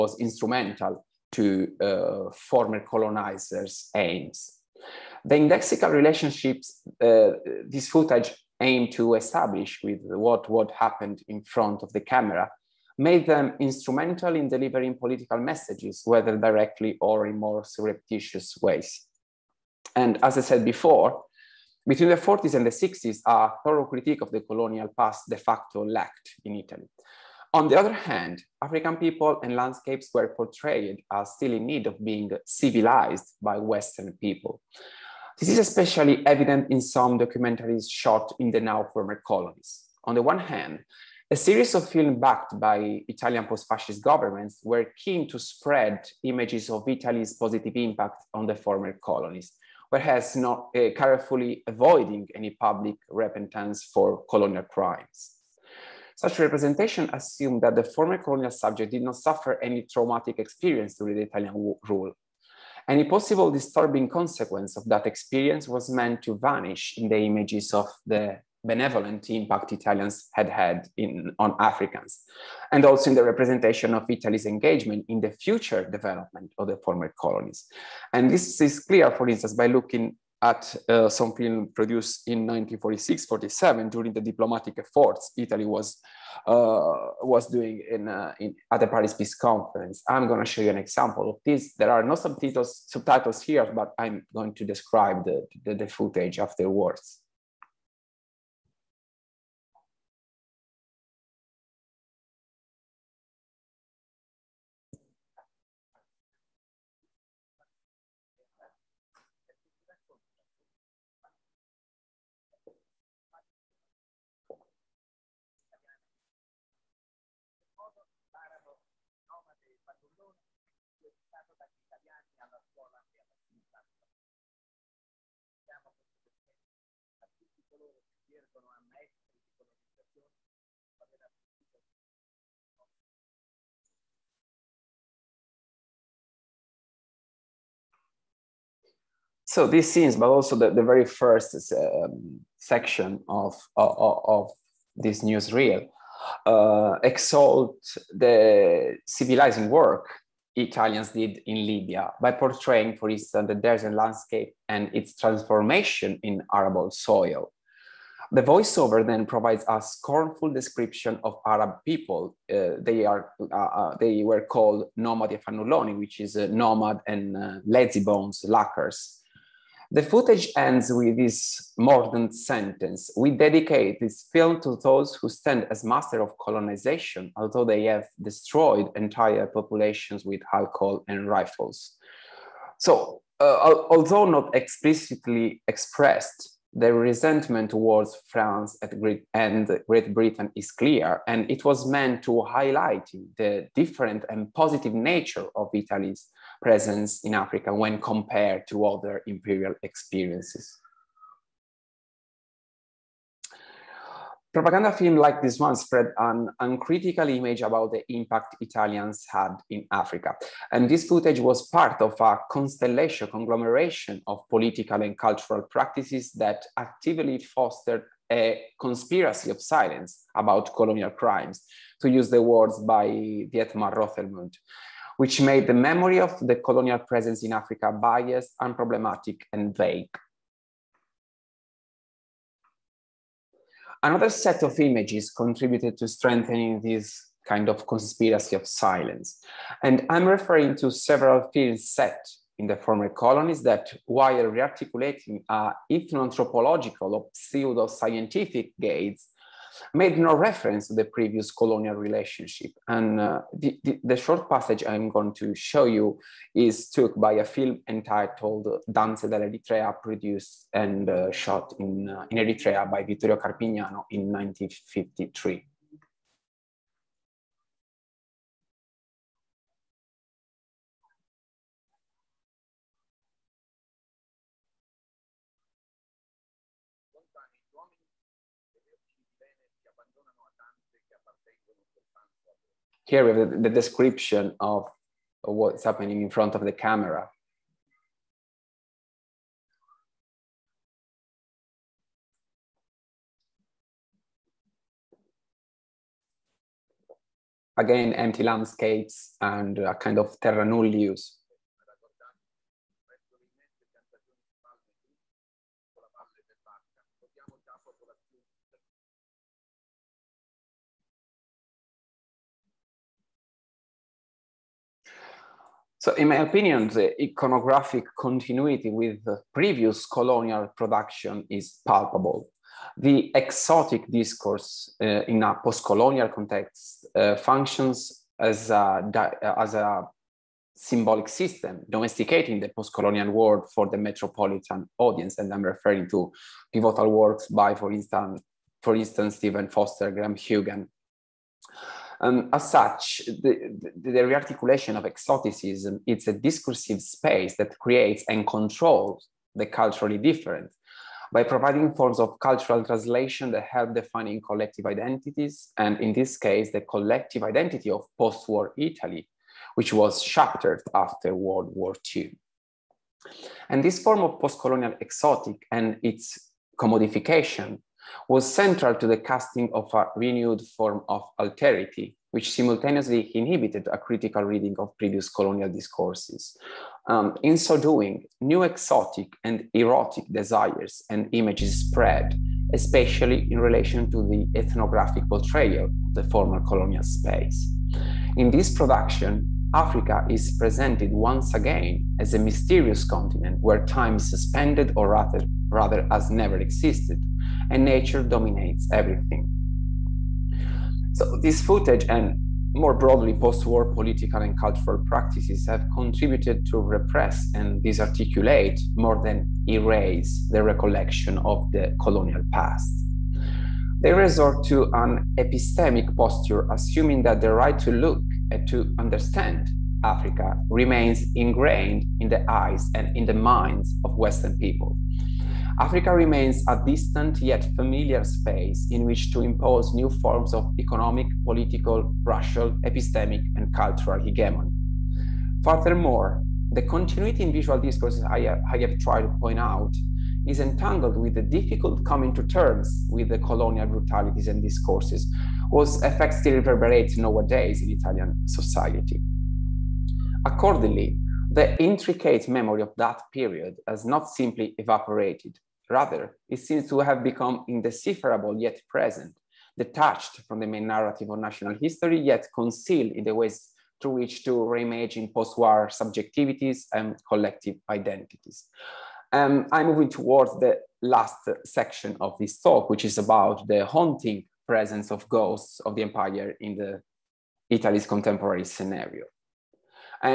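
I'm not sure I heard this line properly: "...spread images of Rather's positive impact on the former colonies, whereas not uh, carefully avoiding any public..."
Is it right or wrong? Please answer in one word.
wrong.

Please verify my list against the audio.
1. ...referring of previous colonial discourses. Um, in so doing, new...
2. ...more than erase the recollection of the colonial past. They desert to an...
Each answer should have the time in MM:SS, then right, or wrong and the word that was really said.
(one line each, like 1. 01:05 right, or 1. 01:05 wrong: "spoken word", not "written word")
1. 06:14 wrong: "reading", not "referring"
2. 06:48 wrong: "resort", not "desert".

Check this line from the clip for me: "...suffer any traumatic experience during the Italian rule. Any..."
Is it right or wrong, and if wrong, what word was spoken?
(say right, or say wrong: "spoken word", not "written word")
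right.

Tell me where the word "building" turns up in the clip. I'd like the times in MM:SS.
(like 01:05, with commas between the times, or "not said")
not said.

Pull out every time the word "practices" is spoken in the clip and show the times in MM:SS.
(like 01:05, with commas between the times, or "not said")
03:35, 06:44.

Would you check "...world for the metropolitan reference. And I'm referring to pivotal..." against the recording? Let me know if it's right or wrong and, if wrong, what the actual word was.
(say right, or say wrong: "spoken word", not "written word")
wrong: "audience", not "reference".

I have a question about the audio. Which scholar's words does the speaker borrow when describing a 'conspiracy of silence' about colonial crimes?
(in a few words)
Dietmar Rothermund.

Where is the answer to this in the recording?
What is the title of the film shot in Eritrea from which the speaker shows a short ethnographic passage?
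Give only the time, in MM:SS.
04:18.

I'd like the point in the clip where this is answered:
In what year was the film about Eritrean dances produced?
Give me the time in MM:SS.
04:24.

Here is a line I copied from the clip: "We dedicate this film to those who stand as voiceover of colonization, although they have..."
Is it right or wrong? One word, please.
wrong.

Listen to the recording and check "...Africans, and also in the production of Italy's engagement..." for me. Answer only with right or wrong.
wrong.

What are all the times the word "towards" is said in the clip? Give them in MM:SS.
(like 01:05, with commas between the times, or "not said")
03:07, 07:50.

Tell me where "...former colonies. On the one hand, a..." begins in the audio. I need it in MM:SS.
00:38.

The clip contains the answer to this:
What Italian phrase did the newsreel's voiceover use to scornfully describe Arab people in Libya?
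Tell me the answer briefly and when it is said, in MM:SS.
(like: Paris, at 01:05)
nomadi fanuloni, at 02:44.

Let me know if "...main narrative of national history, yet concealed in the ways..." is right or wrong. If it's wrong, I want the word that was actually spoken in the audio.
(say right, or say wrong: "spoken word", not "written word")
right.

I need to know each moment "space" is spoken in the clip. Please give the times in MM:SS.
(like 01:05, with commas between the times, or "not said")
05:47, 06:27, 07:08.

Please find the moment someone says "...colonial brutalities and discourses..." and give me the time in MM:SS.
07:23.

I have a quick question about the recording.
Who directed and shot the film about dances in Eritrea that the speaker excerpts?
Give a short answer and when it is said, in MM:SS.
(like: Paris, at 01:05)
Vittorio Carpignano, at 04:23.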